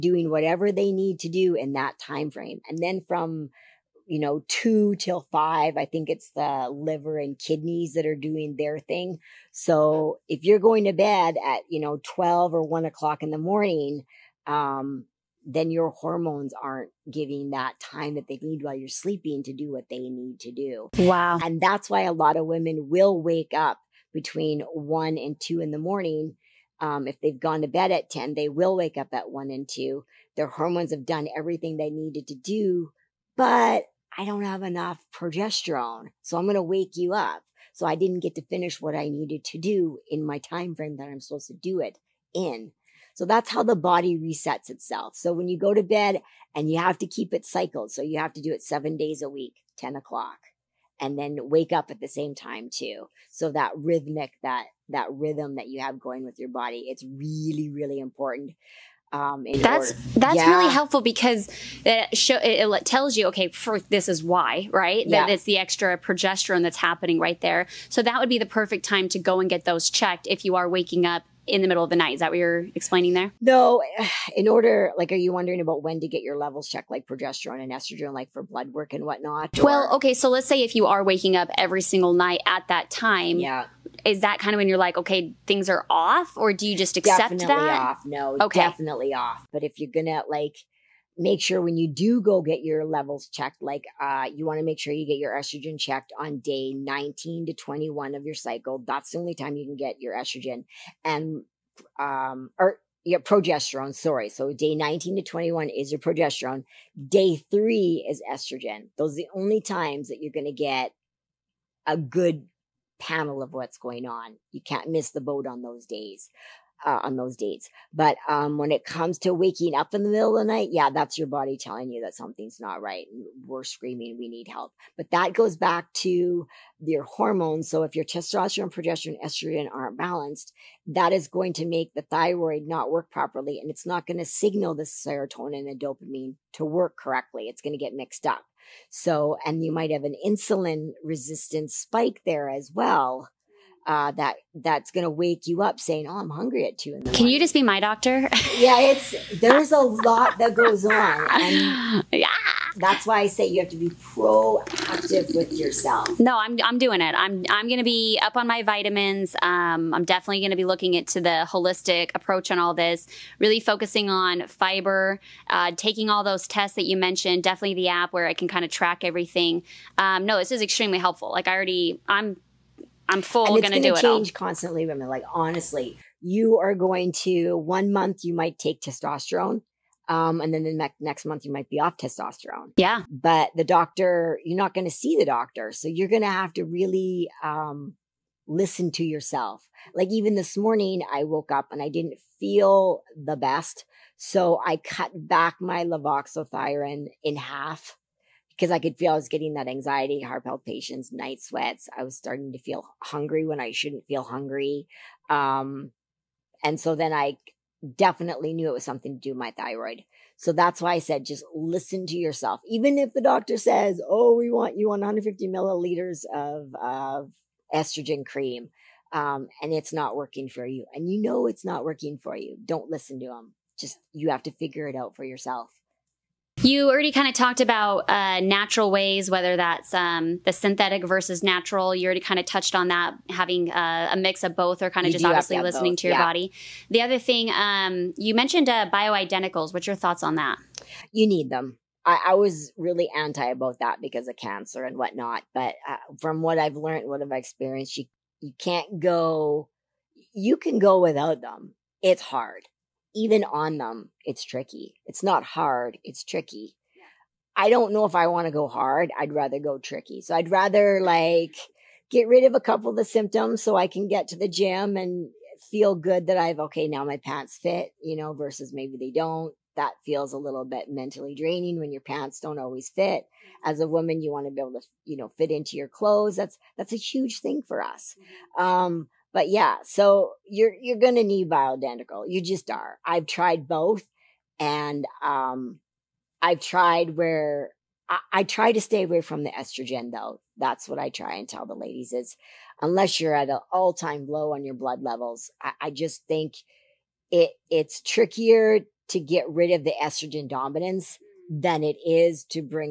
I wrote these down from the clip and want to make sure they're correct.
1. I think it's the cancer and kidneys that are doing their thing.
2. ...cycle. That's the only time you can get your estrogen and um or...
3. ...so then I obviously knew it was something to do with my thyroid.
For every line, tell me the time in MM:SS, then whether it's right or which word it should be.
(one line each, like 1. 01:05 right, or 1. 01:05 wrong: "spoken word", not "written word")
1. 00:05 wrong: "liver", not "cancer"
2. 01:38 right
3. 03:26 wrong: "definitely", not "obviously".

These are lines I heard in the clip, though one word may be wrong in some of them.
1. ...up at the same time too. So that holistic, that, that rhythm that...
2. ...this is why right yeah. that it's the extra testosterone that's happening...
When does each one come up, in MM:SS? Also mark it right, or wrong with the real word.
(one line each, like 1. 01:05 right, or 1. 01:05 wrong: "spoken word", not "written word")
1. 00:51 wrong: "rhythmic", not "holistic"
2. 01:03 wrong: "progesterone", not "testosterone".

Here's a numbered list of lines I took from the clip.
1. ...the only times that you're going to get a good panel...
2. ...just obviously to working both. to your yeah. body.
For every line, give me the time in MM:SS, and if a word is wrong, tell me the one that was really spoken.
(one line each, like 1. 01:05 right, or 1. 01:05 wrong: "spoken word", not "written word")
1. 01:49 right
2. 03:55 wrong: "listening", not "working".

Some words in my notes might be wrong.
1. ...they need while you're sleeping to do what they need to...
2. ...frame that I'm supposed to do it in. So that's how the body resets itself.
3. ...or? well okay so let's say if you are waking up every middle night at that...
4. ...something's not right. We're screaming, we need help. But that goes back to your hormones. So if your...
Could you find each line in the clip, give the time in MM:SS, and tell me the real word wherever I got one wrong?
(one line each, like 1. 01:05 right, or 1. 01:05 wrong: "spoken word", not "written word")
1. 00:18 right
2. 00:40 right
3. 01:19 wrong: "single", not "middle"
4. 02:02 right.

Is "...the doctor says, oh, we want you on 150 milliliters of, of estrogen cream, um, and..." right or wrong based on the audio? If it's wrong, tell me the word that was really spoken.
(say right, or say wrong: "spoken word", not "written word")
right.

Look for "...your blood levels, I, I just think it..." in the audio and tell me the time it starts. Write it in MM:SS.
04:54.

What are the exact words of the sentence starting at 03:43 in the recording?
Just you have to figure it out for yourself.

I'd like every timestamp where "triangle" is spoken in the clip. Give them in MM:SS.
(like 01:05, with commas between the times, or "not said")
not said.